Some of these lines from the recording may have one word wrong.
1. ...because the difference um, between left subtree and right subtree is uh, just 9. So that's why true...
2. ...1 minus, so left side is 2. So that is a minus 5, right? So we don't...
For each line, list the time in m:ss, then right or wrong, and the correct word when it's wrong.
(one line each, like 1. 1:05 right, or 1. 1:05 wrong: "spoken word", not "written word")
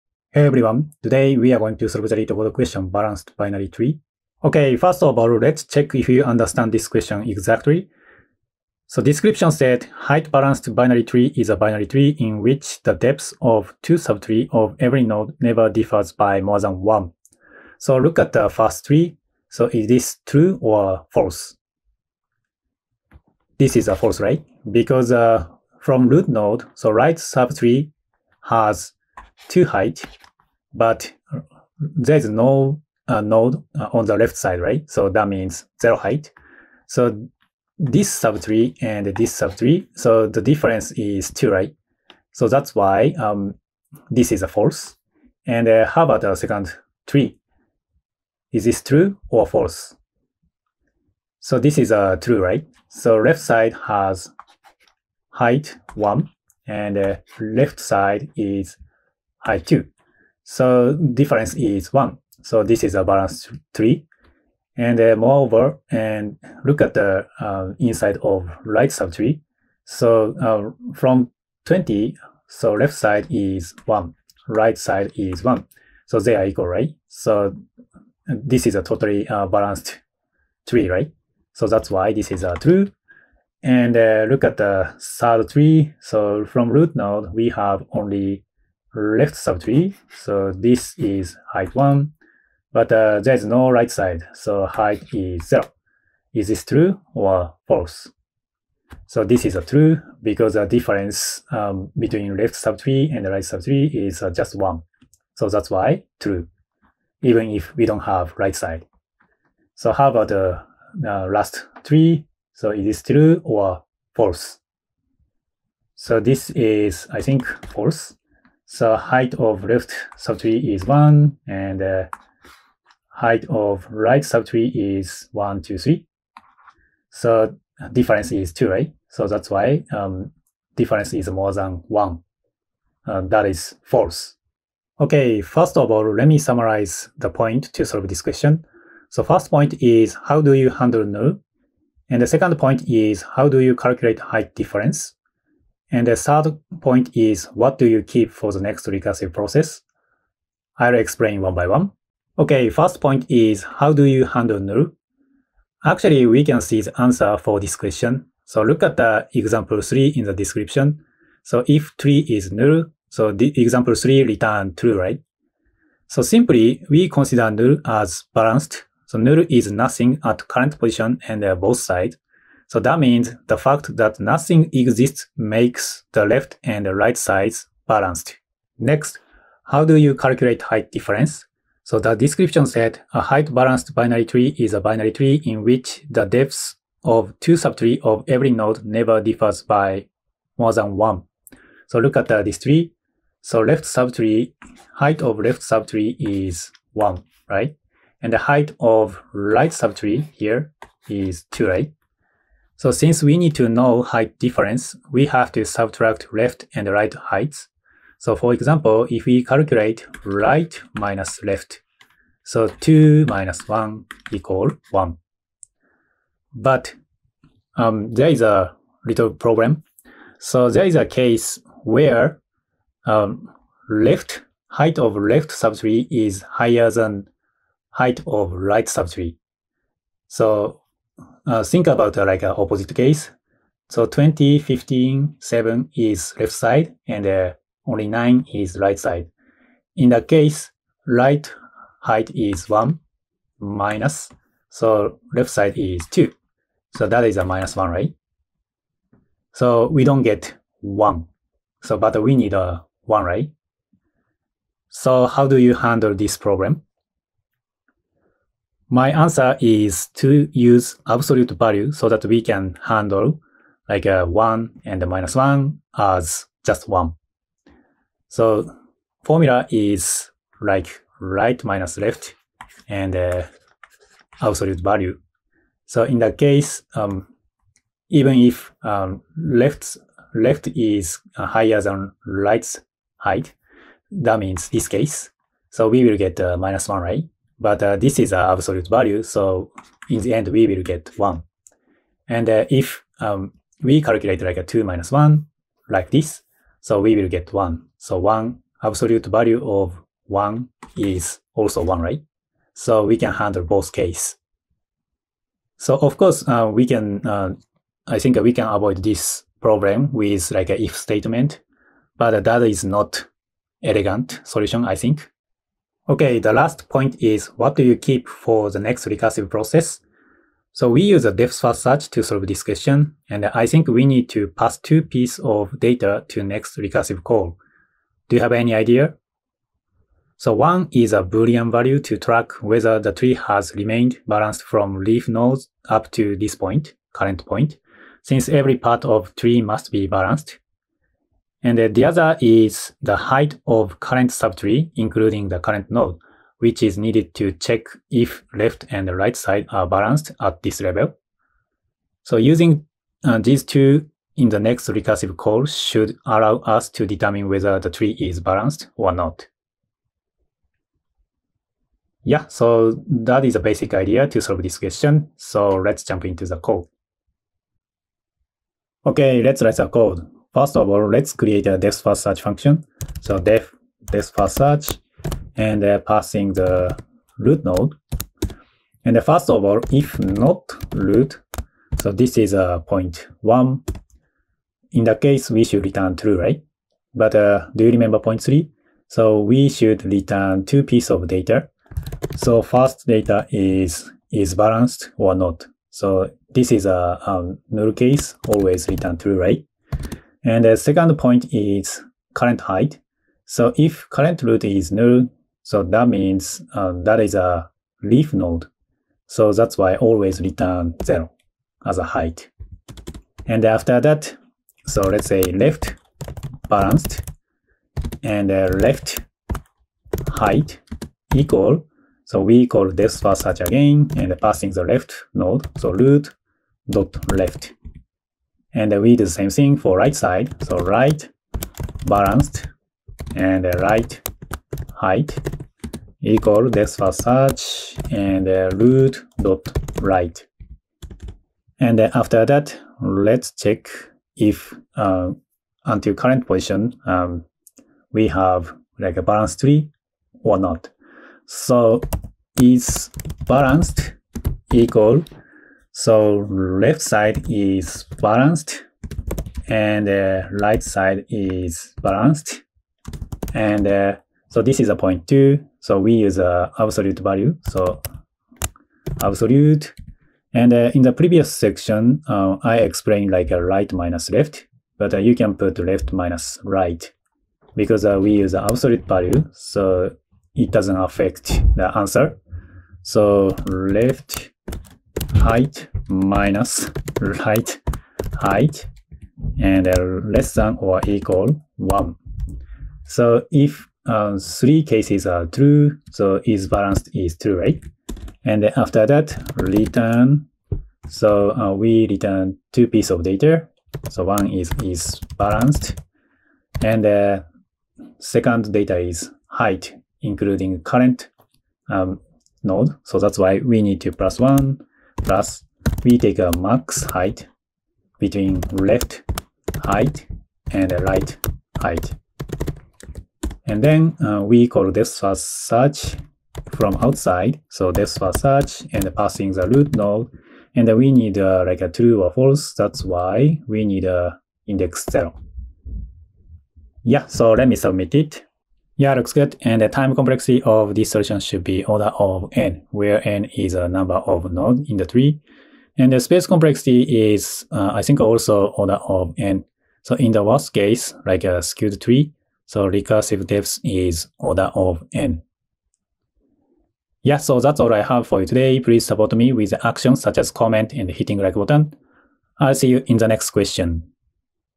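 1. 1:40 wrong: "1", not "9"
2. 4:02 wrong: "1", not "5".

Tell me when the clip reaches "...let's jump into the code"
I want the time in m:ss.
6:05.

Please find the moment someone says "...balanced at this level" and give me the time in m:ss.
5:49.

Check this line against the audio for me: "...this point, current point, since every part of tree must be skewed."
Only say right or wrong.
wrong.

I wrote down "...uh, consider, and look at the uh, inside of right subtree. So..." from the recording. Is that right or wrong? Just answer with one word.
wrong.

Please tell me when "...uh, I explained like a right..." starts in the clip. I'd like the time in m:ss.
7:52.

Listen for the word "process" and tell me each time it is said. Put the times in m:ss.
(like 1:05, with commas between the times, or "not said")
2:29, 5:19.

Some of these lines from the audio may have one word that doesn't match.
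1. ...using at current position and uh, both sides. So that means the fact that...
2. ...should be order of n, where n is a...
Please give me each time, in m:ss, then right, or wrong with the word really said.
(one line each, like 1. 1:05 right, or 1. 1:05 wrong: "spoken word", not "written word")
1. 2:49 wrong: "nothing", not "using"
2. 9:01 right.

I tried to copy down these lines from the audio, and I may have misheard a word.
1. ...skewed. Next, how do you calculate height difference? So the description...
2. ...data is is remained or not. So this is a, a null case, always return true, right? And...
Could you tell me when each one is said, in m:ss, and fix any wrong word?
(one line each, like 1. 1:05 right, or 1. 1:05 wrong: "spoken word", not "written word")
1. 2:57 wrong: "balanced", not "skewed"
2. 6:33 wrong: "balanced", not "remained".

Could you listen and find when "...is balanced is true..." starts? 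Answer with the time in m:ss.
8:16.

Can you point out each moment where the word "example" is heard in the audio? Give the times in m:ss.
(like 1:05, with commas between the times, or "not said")
2:39, 2:43, 3:28.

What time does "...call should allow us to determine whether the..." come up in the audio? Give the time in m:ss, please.
5:55.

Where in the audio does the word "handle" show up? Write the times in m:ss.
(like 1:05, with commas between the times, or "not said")
2:20, 2:34, 4:15, 4:22, 5:03.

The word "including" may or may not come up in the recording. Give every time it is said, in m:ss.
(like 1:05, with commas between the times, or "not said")
5:44, 8:30.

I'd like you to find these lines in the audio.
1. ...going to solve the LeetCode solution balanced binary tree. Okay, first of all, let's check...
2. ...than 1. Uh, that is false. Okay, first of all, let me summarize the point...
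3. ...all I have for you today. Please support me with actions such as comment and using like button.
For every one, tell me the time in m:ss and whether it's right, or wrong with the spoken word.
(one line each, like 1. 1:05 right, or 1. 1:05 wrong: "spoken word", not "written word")
1. 0:01 wrong: "question", not "solution"
2. 2:11 right
3. 9:17 wrong: "hitting", not "using".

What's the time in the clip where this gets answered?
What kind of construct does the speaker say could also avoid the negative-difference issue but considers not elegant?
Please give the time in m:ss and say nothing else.
5:10.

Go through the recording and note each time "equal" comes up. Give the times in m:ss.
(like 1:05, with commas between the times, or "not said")
1:16, 3:34, 7:01, 7:16, 7:34, 8:11.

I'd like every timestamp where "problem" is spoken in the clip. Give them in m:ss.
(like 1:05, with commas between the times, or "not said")
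3:39, 4:16, 5:09.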